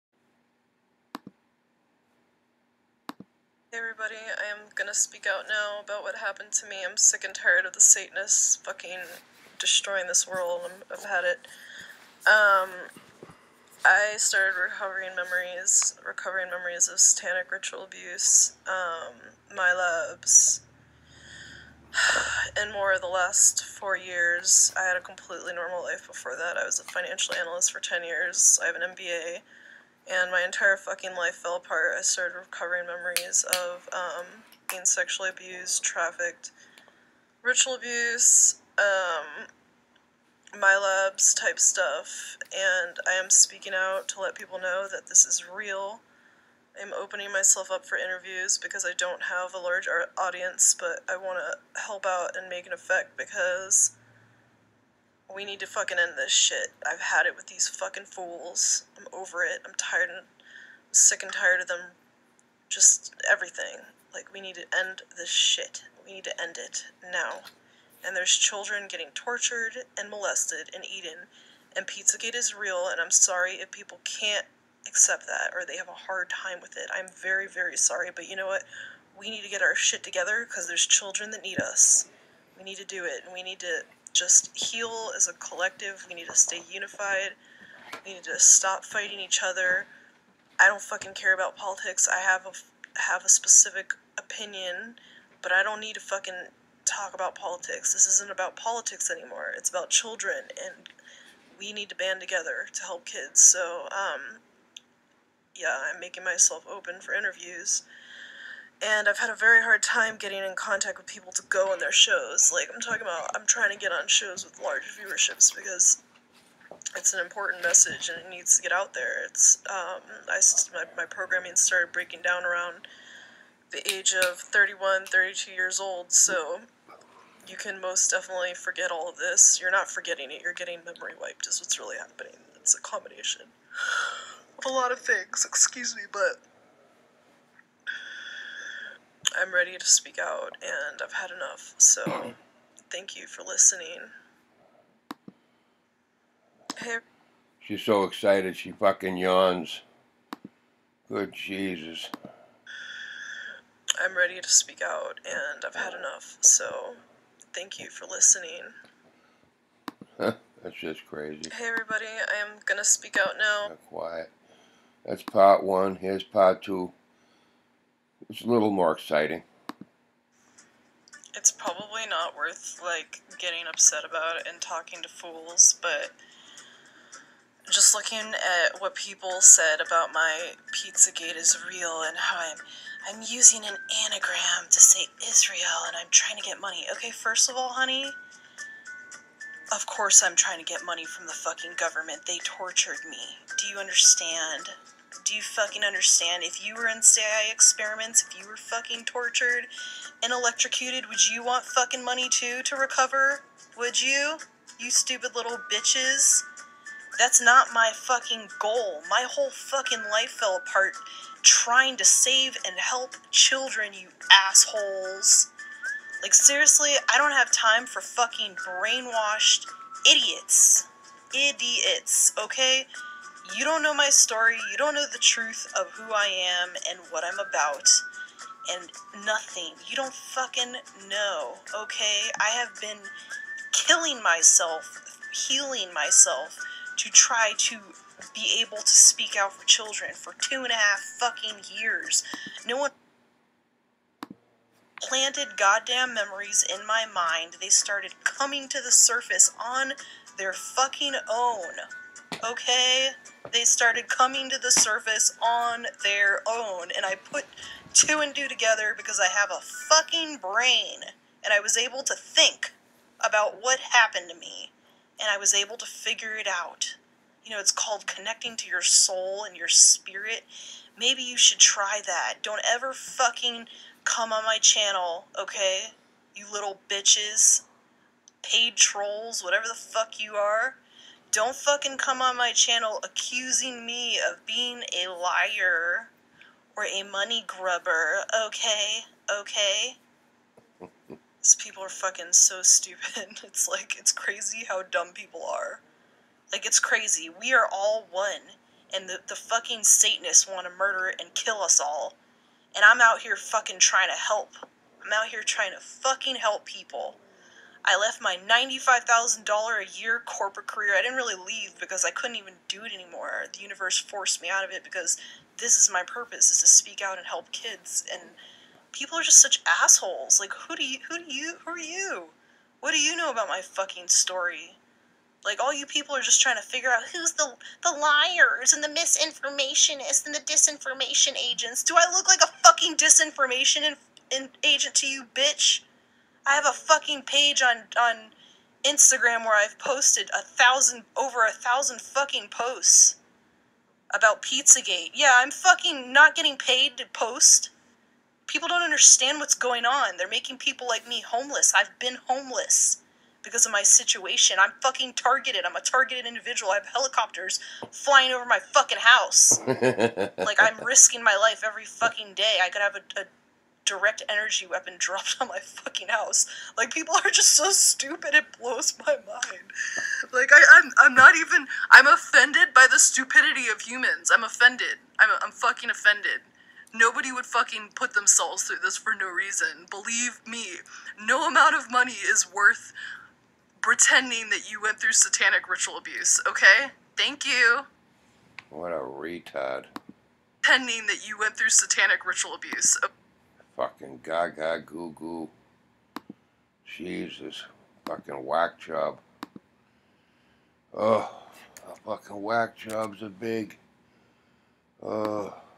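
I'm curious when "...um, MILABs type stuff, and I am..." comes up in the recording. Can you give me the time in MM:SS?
00:38.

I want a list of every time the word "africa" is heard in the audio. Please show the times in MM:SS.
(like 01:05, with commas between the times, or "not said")
not said.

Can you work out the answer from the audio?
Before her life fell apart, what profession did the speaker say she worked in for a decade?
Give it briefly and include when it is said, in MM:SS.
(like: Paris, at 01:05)
financial analyst, at 00:26.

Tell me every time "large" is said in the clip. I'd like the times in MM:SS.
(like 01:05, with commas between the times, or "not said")
00:49, 01:54.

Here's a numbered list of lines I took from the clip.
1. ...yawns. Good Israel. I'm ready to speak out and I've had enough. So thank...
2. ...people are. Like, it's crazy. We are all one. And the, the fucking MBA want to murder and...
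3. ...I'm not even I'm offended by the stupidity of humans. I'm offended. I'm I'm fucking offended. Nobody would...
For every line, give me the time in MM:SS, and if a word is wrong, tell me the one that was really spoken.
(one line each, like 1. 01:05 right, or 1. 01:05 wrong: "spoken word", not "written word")
1. 02:29 wrong: "Jesus", not "Israel"
2. 04:55 wrong: "Satanists", not "MBA"
3. 06:11 right.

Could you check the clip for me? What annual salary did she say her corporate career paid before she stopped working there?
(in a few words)
$95,000.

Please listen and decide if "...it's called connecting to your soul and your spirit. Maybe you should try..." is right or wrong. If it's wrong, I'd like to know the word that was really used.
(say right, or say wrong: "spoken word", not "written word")
right.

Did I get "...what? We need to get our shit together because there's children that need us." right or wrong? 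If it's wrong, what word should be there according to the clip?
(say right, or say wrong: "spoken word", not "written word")
right.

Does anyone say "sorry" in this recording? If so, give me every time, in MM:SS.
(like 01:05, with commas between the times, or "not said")
01:13, 01:17.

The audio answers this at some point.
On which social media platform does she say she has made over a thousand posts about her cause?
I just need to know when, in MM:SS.
05:38.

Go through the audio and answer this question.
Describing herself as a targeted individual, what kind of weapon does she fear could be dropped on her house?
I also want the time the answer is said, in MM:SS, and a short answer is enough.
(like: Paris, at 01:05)
direct energy weapon, at 06:03.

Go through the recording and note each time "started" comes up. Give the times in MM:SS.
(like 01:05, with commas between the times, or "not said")
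00:14, 00:32, 02:01, 04:07, 04:13.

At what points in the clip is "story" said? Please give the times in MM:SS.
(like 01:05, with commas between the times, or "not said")
03:44, 05:24.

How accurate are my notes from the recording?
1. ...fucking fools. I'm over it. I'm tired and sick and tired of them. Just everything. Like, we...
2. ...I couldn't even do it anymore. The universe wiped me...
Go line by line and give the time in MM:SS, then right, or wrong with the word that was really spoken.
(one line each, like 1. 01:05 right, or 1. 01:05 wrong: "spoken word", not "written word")
1. 00:57 right
2. 05:12 wrong: "forced", not "wiped".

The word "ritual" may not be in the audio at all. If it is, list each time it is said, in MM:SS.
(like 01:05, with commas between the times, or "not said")
00:17, 00:37, 06:25, 06:32.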